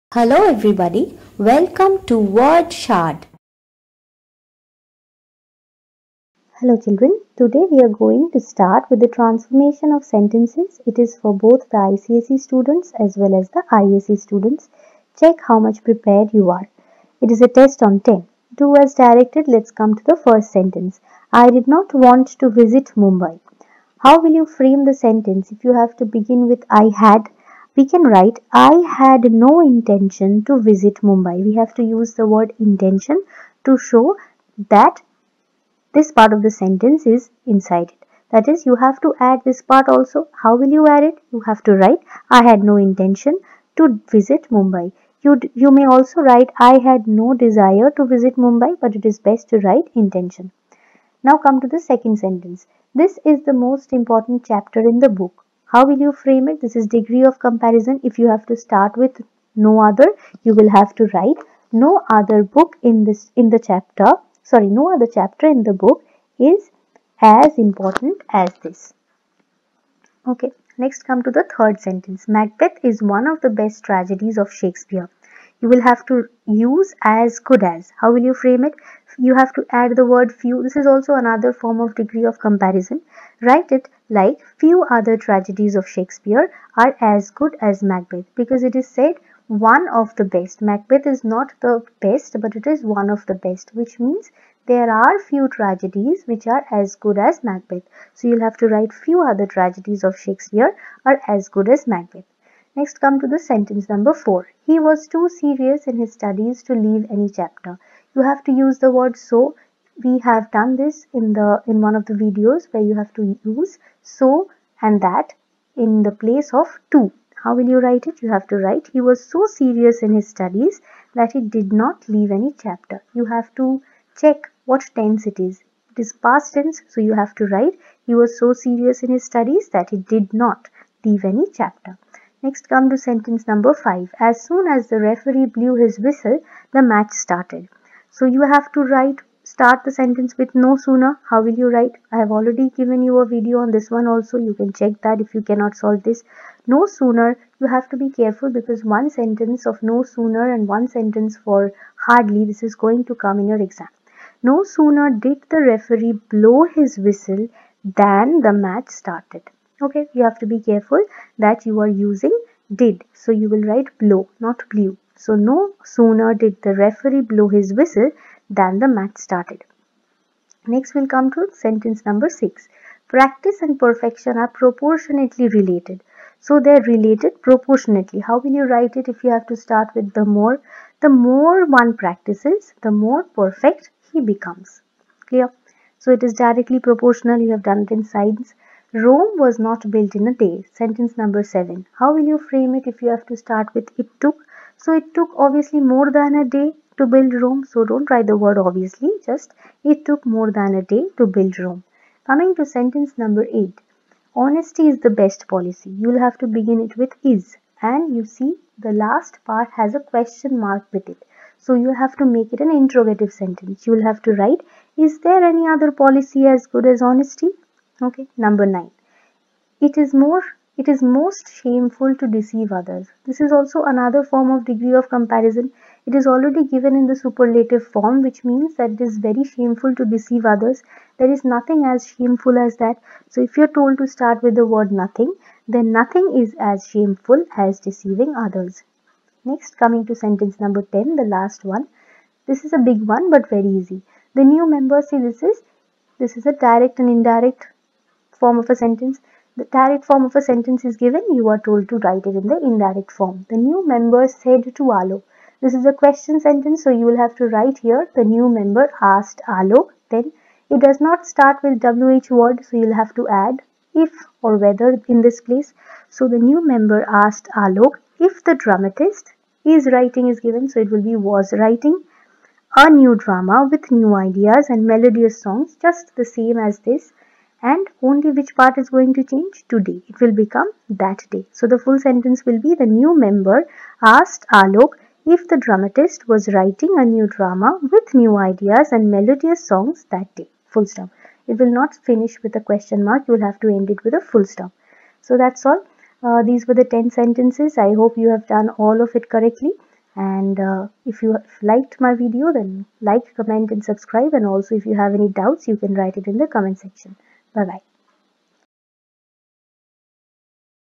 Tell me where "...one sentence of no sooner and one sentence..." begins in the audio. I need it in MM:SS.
02:28.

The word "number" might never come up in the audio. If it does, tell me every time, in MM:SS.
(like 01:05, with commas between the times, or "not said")
01:43, 02:13, 02:52, 03:11, 03:23, 03:38, 04:00.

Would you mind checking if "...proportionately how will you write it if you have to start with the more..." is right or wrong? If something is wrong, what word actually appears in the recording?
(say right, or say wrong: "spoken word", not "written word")
right.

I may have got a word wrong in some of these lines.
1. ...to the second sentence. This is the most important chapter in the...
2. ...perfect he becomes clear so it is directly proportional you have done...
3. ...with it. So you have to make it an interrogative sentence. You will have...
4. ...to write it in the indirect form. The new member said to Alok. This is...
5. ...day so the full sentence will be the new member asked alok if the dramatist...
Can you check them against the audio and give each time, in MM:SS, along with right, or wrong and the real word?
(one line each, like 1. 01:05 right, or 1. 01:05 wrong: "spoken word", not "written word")
1. 00:51 right
2. 03:03 right
3. 03:30 right
4. 04:11 right
5. 04:41 right.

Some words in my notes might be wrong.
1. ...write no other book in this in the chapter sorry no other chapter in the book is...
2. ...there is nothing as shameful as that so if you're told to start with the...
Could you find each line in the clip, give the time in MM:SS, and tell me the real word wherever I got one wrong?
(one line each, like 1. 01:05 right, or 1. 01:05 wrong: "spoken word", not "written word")
1. 01:01 right
2. 03:51 right.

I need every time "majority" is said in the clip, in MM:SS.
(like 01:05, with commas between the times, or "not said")
not said.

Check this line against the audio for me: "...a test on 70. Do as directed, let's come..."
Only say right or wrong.
wrong.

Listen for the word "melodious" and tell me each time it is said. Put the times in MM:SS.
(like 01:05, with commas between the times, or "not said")
04:34, 04:49.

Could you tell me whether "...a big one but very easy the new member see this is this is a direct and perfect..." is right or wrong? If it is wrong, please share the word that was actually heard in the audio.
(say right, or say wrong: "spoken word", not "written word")
wrong: "indirect", not "perfect".